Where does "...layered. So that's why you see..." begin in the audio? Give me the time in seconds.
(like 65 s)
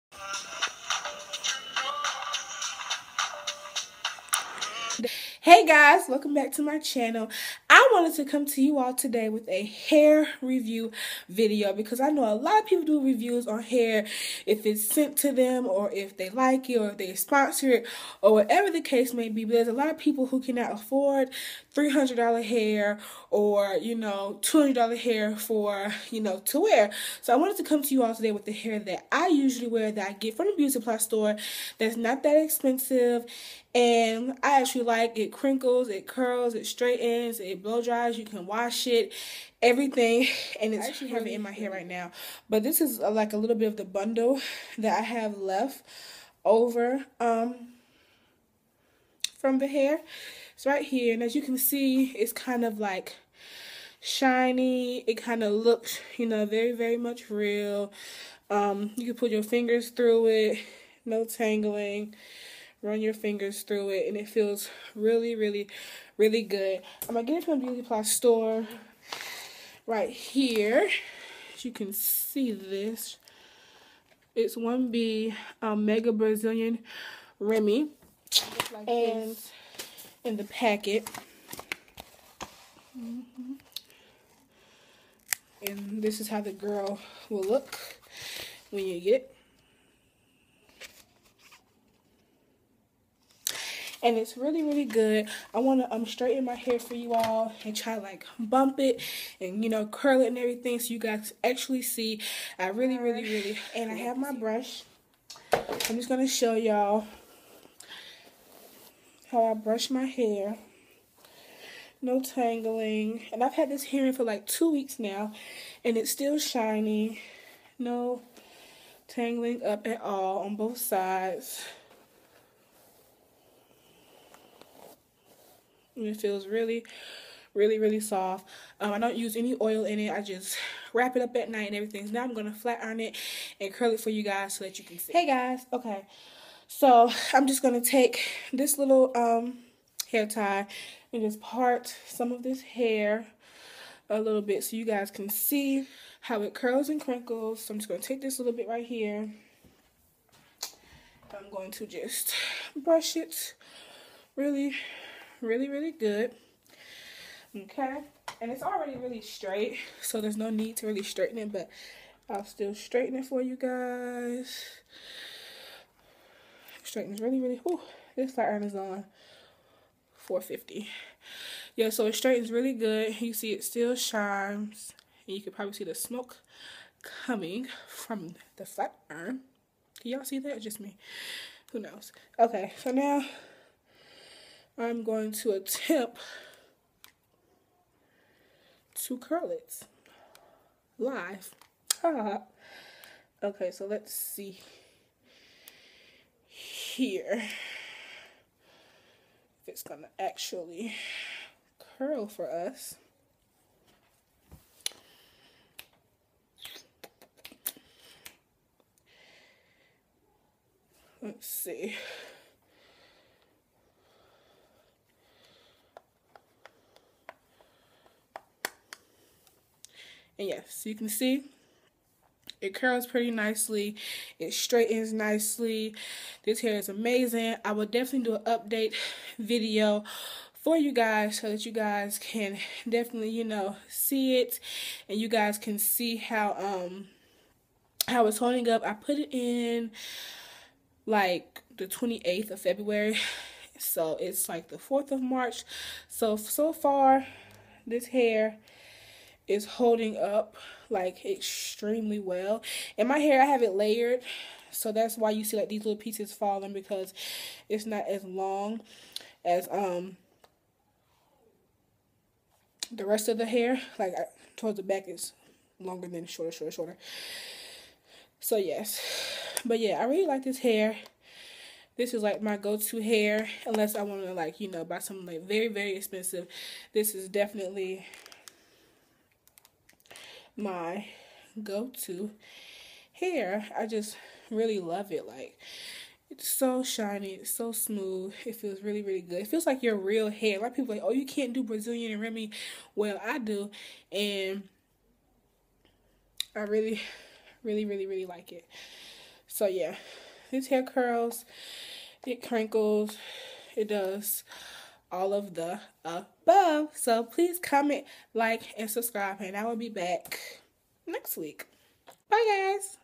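253 s.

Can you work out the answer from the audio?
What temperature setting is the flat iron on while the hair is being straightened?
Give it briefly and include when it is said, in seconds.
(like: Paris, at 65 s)
450, at 170 s.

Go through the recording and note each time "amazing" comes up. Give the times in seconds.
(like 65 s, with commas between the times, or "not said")
226 s.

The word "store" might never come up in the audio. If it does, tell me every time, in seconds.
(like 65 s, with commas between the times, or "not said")
30 s, 68 s.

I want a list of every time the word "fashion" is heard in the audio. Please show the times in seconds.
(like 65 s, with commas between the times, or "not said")
not said.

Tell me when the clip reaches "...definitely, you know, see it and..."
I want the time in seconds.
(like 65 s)
232 s.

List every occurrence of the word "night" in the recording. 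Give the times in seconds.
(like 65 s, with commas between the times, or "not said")
131 s.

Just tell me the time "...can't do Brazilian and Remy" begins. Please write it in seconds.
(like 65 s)
291 s.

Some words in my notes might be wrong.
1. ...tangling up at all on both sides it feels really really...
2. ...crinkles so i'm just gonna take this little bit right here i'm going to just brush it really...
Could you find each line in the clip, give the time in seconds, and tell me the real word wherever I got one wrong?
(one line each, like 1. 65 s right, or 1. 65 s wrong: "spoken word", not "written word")
1. 119 s right
2. 147 s right.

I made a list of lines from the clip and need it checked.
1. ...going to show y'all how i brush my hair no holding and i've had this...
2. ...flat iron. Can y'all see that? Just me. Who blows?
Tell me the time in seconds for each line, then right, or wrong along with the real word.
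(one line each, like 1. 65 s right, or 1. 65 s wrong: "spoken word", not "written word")
1. 106 s wrong: "tangling", not "holding"
2. 178 s wrong: "knows", not "blows".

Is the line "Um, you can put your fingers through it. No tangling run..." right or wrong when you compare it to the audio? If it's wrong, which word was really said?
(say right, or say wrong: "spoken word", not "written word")
right.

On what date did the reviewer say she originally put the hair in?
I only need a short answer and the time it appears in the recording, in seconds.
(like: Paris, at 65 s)
28th of February, at 241 s.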